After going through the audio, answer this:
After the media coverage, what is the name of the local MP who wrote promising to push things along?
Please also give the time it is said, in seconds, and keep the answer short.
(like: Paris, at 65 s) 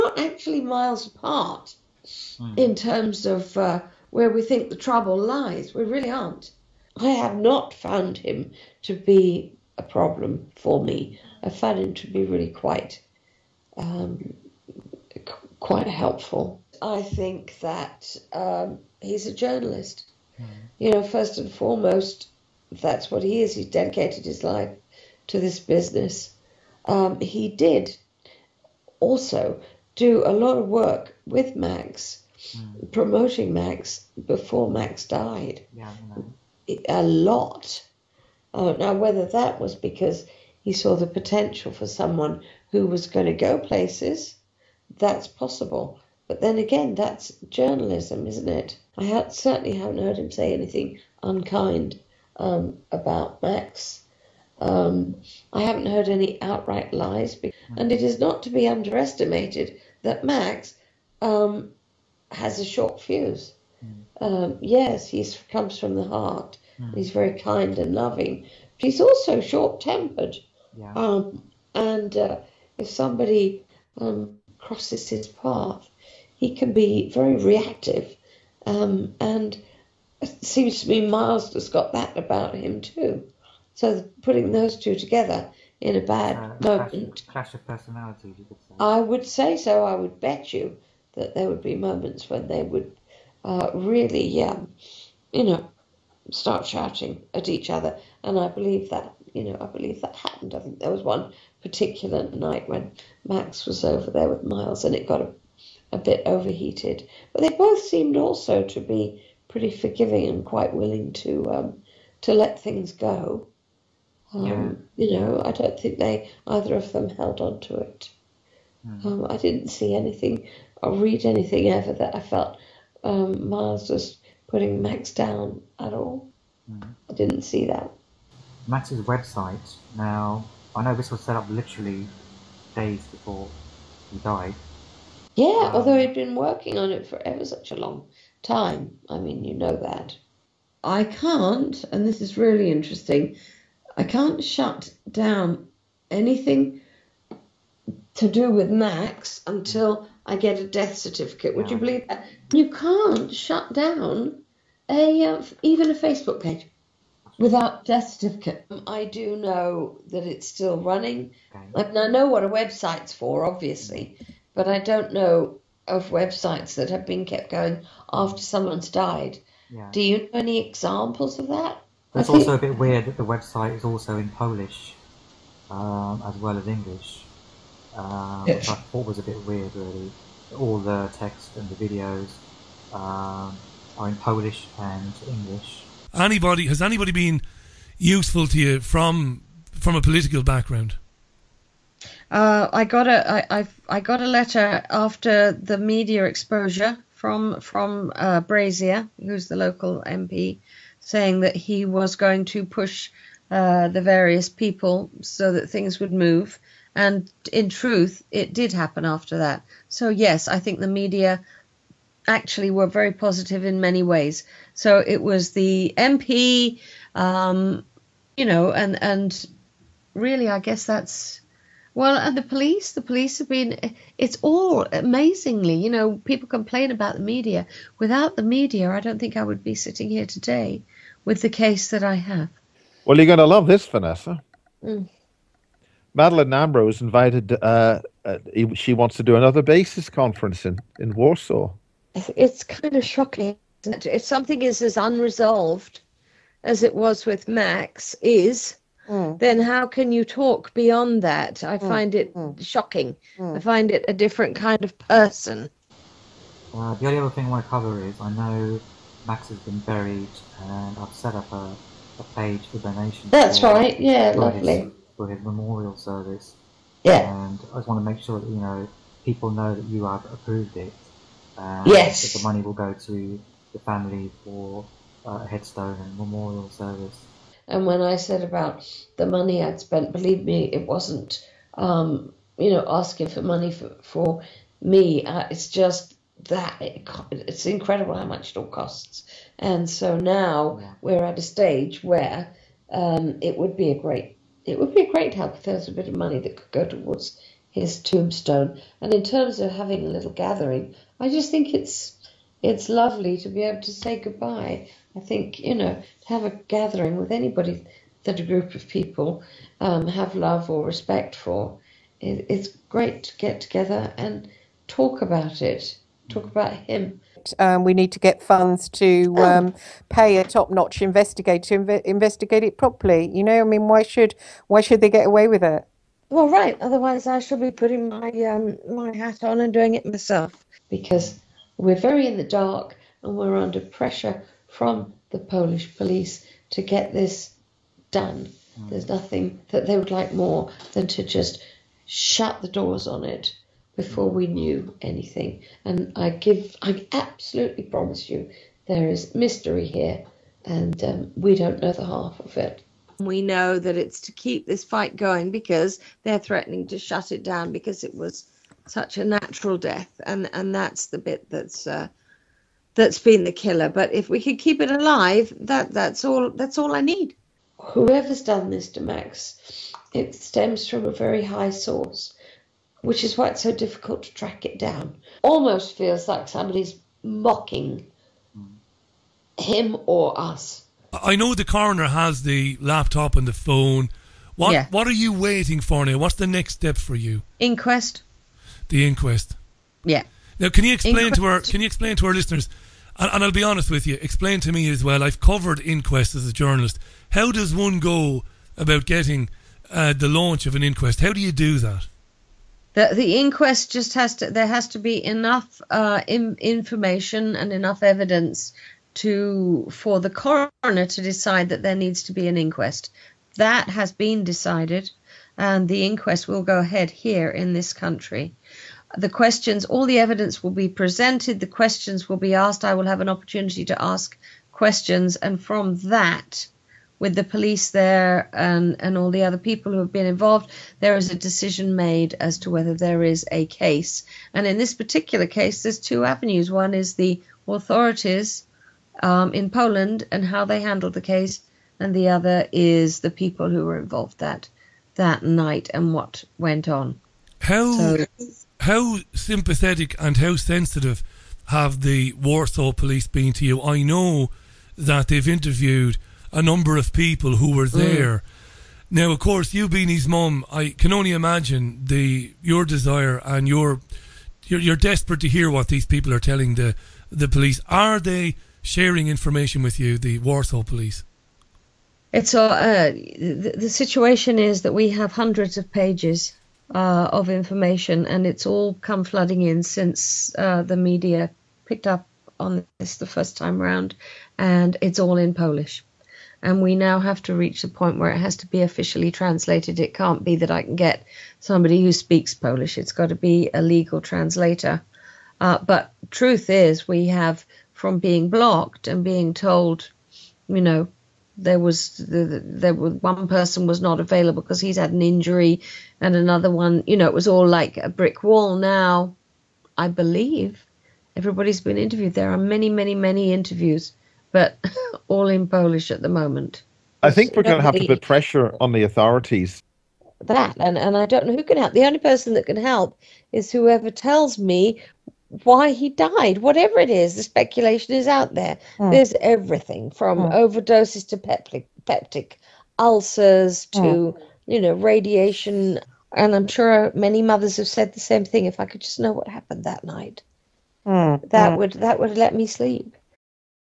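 Brazier, at 198 s.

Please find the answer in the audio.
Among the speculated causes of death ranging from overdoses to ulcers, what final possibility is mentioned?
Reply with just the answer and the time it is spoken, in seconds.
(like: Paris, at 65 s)
Radiation, at 534 s.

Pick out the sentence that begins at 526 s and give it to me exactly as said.
Whatever it is, the speculation is out there.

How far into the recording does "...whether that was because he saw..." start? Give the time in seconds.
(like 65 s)
38 s.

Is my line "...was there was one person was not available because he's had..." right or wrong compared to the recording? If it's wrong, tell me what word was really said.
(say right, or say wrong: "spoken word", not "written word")
right.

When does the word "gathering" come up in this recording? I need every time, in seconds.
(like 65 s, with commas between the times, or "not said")
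300 s, 306 s.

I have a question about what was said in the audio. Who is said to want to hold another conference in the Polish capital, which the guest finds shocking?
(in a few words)
Madeline Ambrose.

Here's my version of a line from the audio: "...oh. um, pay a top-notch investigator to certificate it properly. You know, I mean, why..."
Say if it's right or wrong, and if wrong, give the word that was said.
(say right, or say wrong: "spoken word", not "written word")
wrong: "investigate", not "certificate".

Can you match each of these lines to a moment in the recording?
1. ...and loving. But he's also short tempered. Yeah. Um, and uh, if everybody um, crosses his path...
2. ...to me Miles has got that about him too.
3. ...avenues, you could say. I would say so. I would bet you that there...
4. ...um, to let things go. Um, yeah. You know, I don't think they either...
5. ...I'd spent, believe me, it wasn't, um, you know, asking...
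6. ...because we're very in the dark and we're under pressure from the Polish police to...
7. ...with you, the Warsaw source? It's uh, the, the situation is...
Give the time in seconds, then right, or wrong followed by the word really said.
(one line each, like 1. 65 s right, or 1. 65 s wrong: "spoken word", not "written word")
1. 67 s wrong: "somebody", not "everybody"
2. 80 s right
3. 87 s wrong: "personalities", not "avenues"
4. 111 s right
5. 279 s right
6. 330 s right
7. 469 s wrong: "police", not "source".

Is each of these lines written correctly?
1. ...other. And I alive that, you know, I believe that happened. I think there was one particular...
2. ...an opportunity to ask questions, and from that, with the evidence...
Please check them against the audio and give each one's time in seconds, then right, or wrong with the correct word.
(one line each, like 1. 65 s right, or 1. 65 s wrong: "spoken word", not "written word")
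1. 97 s wrong: "believe", not "alive"
2. 423 s wrong: "police", not "evidence".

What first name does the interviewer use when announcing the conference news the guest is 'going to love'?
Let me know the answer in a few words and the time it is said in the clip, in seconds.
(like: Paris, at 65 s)
Vanessa, at 233 s.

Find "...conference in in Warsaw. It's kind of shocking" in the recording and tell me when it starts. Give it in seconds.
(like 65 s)
240 s.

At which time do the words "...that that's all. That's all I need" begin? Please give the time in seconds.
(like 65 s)
365 s.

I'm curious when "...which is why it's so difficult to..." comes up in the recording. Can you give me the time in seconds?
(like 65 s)
373 s.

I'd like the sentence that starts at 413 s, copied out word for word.
That has been decided, and the inquest will go ahead here in this country.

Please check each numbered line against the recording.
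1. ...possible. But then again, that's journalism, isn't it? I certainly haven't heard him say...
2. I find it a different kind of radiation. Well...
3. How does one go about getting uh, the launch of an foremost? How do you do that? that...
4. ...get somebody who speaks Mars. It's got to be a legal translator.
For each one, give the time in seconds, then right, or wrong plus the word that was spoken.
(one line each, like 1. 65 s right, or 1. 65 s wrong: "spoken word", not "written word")
1. 45 s right
2. 253 s wrong: "person", not "radiation"
3. 397 s wrong: "inquest", not "foremost"
4. 490 s wrong: "Polish", not "Mars".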